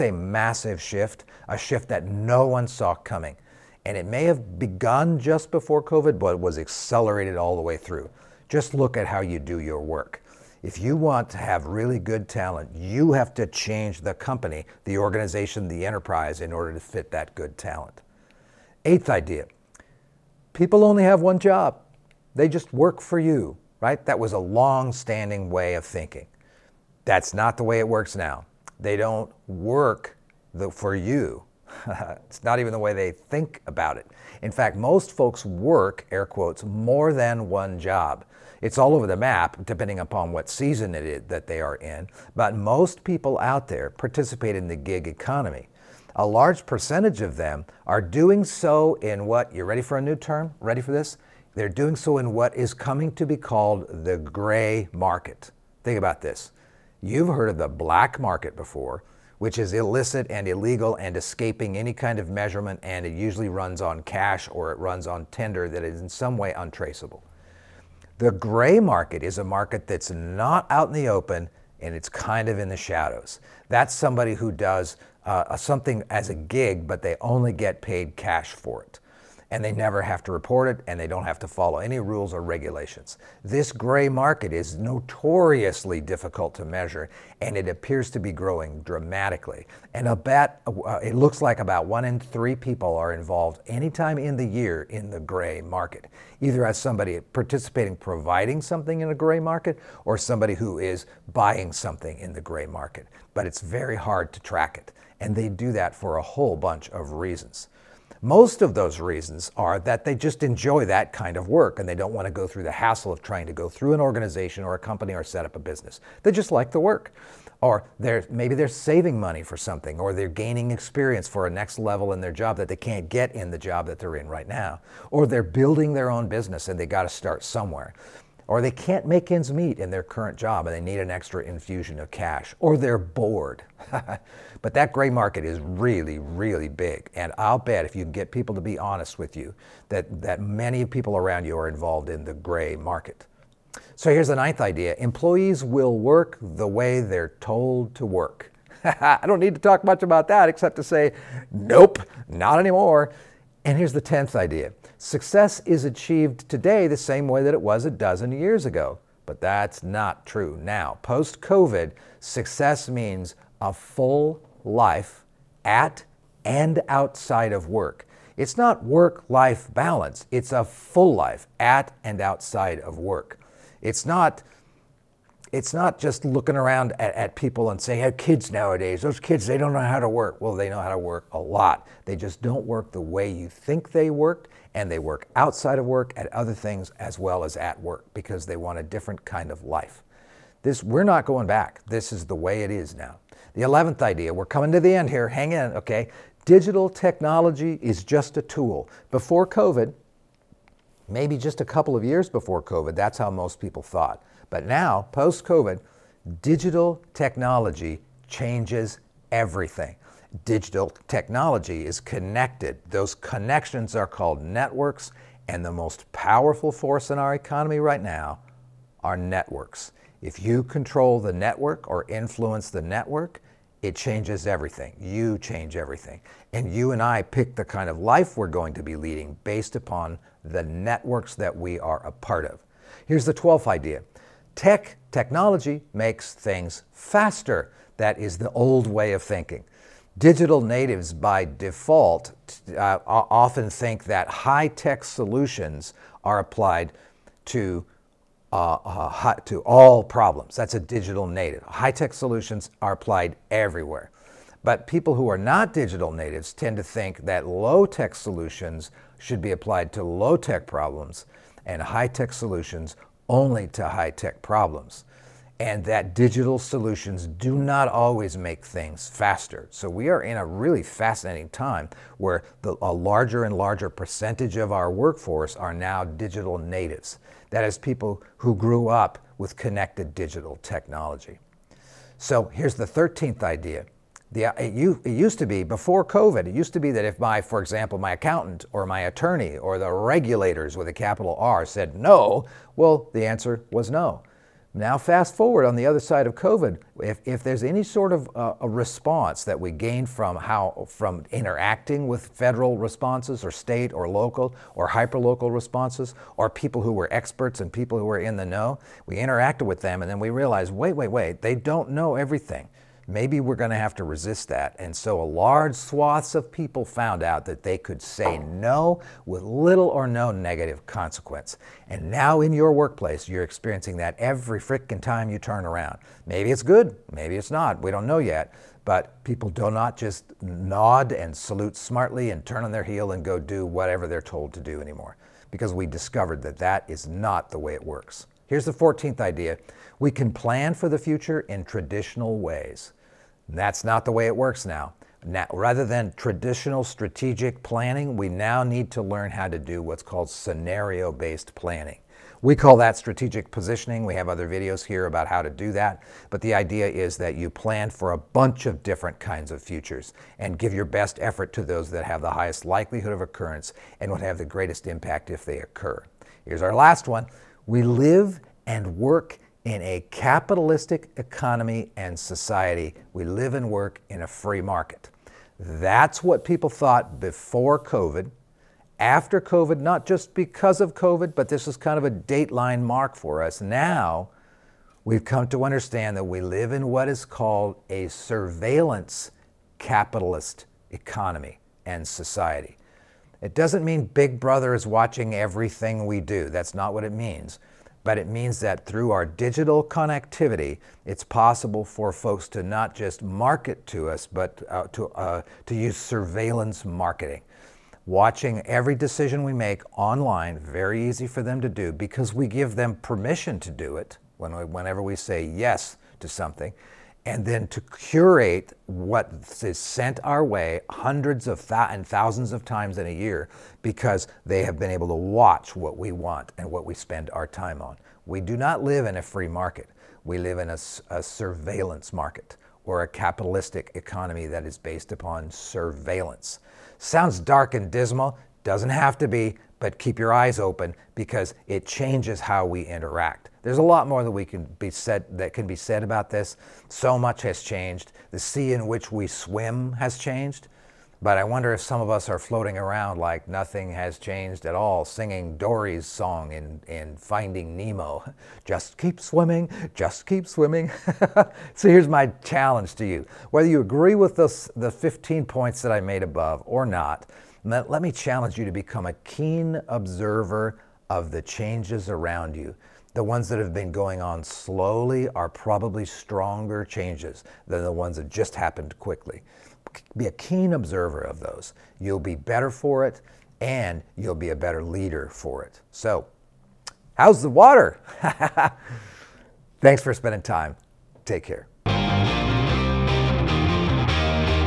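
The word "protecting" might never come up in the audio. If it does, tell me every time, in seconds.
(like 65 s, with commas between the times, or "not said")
not said.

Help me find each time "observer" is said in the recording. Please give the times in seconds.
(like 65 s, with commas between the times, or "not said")
469 s, 480 s.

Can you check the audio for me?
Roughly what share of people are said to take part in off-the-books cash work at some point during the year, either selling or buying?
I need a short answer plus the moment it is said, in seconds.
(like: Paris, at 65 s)
one in three, at 91 s.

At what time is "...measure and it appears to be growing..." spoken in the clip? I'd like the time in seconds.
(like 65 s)
86 s.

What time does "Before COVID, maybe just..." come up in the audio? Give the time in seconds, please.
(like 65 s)
199 s.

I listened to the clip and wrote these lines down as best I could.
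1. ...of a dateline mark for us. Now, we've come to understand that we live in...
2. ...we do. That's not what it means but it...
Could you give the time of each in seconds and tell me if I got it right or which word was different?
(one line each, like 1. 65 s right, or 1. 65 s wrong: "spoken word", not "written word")
1. 381 s right
2. 396 s right.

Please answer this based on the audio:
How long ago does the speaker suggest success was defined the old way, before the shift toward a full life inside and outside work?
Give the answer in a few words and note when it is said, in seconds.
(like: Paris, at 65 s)
a dozen years, at 157 s.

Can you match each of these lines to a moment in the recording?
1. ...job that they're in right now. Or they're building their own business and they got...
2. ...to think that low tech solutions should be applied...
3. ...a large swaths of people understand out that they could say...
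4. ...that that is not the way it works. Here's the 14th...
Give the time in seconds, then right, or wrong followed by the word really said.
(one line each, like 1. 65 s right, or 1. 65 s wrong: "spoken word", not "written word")
1. 123 s right
2. 256 s right
3. 315 s wrong: "found", not "understand"
4. 336 s right.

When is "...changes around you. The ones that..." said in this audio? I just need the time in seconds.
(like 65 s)
471 s.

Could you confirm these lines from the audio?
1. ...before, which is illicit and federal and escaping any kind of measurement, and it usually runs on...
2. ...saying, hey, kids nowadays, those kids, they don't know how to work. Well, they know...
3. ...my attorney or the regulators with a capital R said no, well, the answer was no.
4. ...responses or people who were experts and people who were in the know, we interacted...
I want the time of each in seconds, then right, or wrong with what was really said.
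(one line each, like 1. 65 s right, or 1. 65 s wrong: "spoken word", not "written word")
1. 58 s wrong: "illegal", not "federal"
2. 177 s right
3. 288 s right
4. 305 s right.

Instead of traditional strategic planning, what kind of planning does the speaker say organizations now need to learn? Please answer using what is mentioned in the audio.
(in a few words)
scenario based planning.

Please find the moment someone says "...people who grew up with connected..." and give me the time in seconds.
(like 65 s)
277 s.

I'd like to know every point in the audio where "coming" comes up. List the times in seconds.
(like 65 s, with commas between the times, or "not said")
2 s, 52 s, 194 s.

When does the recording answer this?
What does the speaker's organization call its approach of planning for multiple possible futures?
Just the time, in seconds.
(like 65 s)
352 s.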